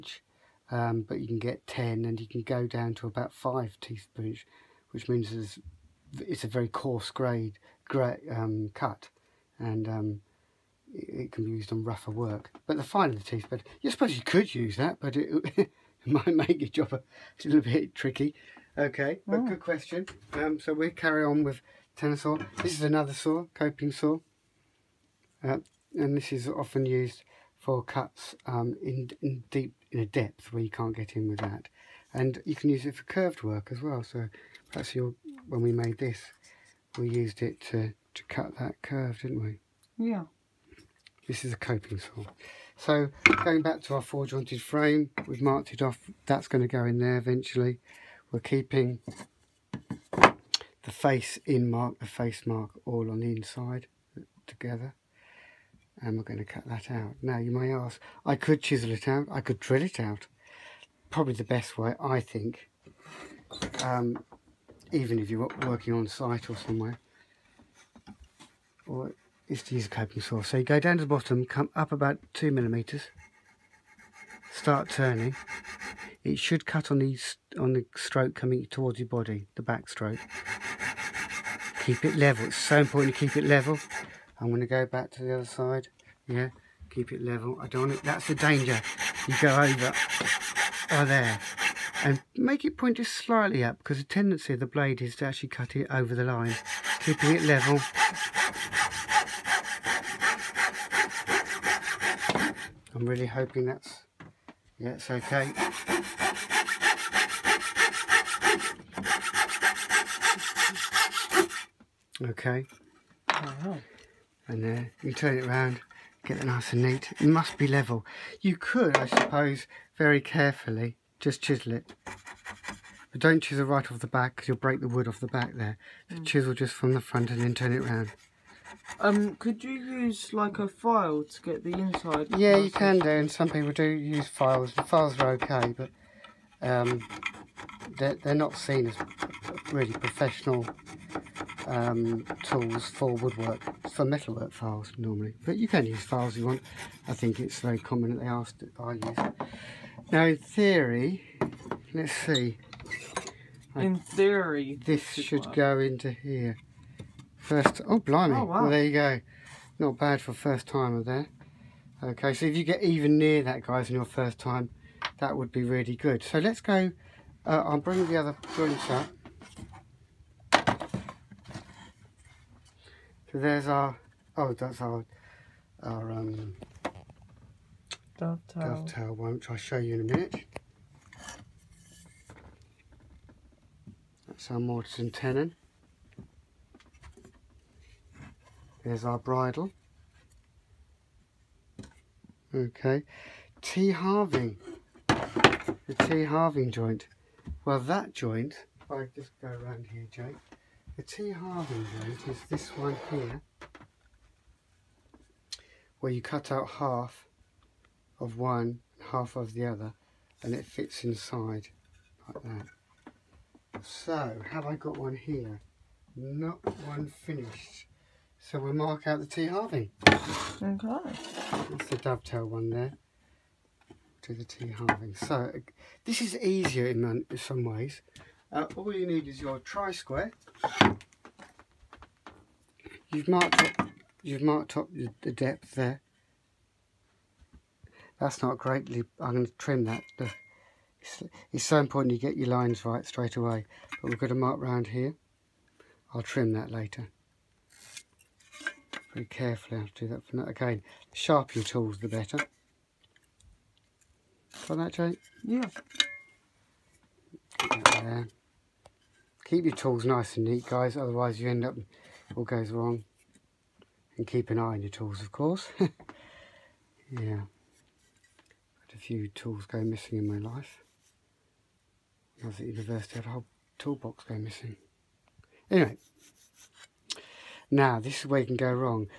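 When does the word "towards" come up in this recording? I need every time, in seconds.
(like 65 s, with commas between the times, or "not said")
78 s.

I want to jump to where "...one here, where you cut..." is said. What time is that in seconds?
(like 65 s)
202 s.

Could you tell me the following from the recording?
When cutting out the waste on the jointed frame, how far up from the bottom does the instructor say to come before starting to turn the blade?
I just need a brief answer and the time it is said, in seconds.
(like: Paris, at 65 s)
2 millimeters, at 72 s.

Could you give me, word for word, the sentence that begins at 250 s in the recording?
Again, the sharper your tools, the better on that Jake?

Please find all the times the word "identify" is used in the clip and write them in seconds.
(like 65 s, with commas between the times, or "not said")
not said.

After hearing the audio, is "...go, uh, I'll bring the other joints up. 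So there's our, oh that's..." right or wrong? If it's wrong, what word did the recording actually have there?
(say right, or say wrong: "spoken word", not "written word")
right.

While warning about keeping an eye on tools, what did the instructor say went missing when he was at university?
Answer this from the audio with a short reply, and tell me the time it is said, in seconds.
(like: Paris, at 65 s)
A whole toolbox, at 273 s.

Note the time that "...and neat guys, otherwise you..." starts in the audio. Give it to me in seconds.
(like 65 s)
260 s.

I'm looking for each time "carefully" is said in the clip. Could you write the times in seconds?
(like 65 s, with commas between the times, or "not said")
120 s, 249 s.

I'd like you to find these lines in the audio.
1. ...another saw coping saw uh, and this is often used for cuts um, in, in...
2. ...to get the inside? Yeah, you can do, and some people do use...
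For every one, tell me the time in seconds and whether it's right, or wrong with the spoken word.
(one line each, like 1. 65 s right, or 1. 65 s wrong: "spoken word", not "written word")
1. 22 s right
2. 131 s right.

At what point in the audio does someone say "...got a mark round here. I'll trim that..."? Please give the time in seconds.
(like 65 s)
244 s.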